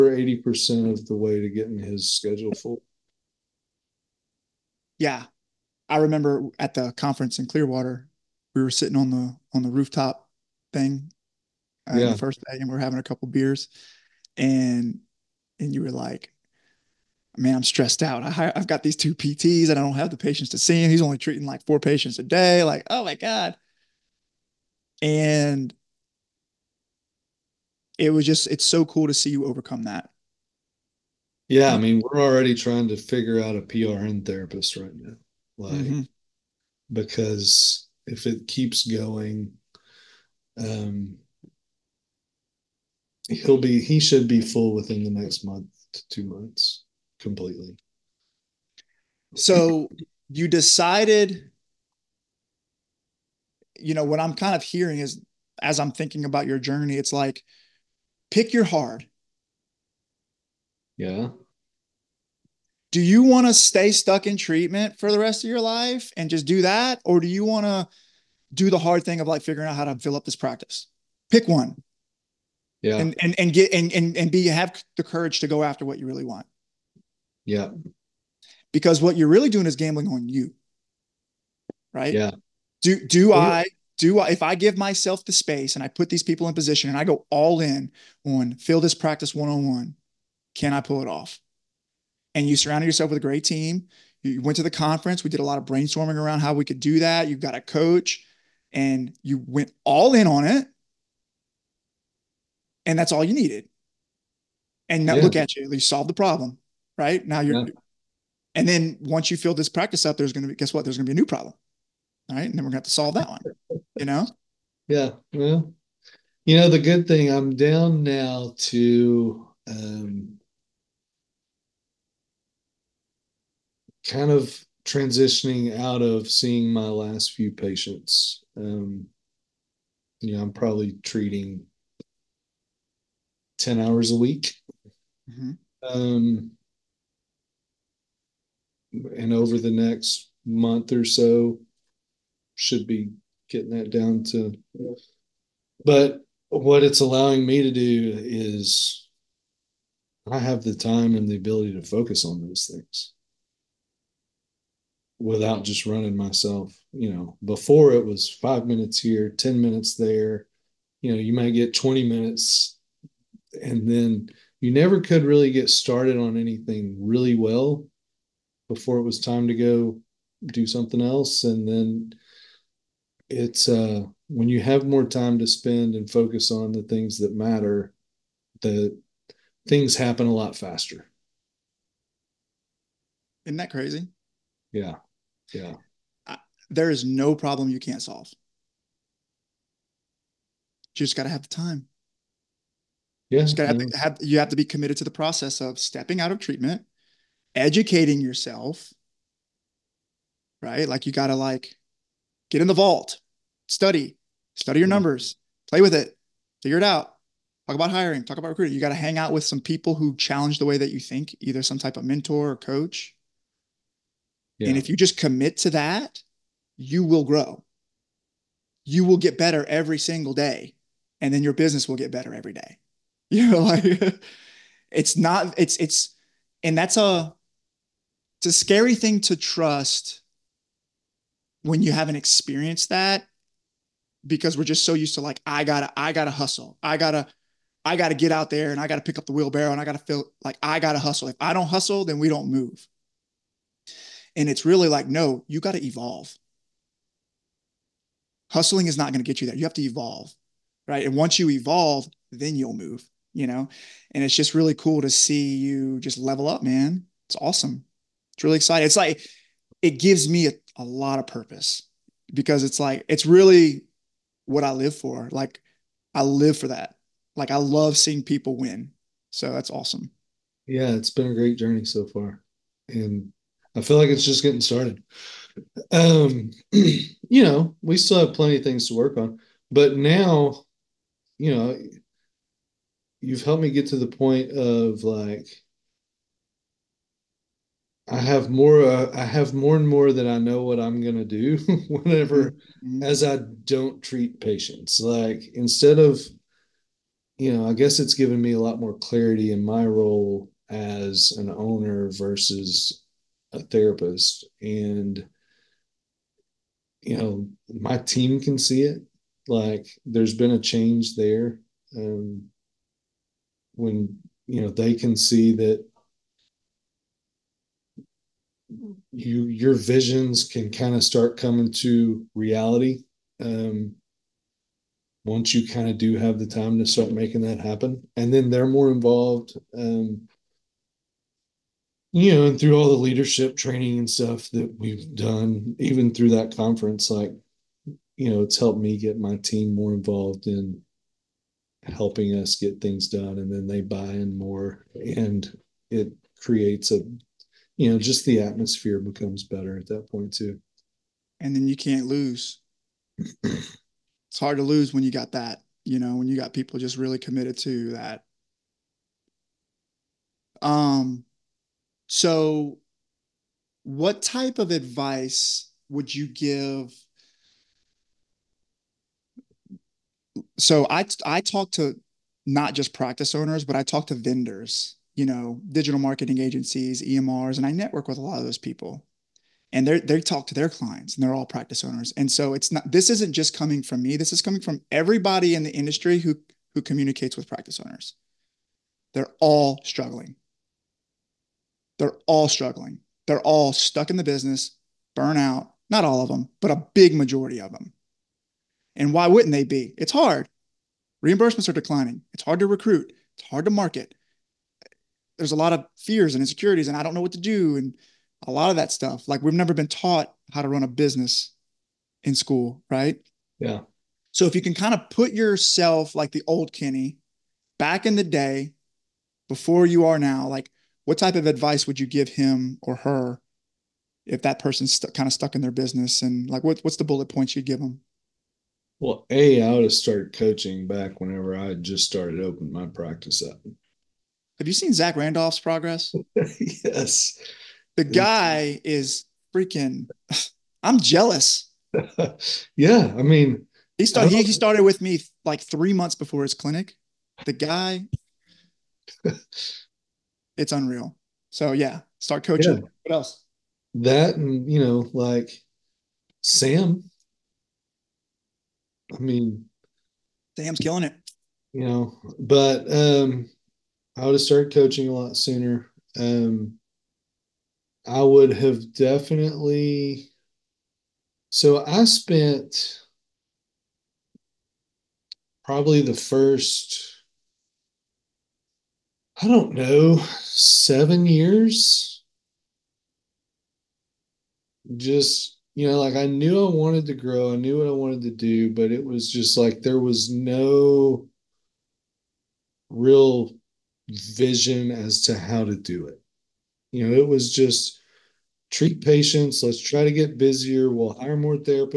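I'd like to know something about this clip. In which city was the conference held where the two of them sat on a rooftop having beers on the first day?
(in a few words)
Clearwater.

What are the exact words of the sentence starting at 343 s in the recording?
And then they buy in more and it creates a, you know, just the atmosphere becomes better at that point too.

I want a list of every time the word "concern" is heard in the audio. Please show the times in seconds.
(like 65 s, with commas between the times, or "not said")
not said.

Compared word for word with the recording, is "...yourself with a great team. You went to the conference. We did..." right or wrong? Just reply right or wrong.
right.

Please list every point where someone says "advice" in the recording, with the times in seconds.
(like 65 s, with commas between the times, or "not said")
364 s, 421 s.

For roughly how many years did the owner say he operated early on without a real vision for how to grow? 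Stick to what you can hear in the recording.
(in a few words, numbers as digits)
7.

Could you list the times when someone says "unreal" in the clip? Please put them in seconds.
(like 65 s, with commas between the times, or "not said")
450 s.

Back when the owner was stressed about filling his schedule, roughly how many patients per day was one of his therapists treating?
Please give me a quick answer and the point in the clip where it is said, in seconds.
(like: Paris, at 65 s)
4, at 21 s.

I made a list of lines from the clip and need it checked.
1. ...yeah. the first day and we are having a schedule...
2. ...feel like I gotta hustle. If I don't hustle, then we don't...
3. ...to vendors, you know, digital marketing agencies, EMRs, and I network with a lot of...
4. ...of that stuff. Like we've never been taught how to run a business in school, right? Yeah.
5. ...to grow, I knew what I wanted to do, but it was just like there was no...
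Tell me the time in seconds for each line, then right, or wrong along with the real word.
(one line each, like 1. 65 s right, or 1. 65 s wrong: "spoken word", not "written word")
1. 11 s wrong: "couple", not "schedule"
2. 239 s right
3. 374 s right
4. 408 s right
5. 487 s right.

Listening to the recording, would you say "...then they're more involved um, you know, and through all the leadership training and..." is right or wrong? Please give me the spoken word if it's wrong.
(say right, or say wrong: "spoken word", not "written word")
right.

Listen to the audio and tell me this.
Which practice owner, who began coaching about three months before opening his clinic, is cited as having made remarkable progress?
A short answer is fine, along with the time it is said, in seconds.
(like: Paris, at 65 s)
Zach Randolph, at 434 s.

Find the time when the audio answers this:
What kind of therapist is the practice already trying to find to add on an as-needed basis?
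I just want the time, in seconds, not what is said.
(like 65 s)
33 s.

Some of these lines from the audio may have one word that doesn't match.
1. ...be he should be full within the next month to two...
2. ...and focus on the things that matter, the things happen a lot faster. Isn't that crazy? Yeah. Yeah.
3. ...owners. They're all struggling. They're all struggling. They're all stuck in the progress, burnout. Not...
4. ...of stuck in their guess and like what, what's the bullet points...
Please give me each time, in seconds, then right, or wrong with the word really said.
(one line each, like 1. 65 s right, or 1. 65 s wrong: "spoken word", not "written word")
1. 43 s right
2. 175 s right
3. 387 s wrong: "business", not "progress"
4. 425 s wrong: "business", not "guess".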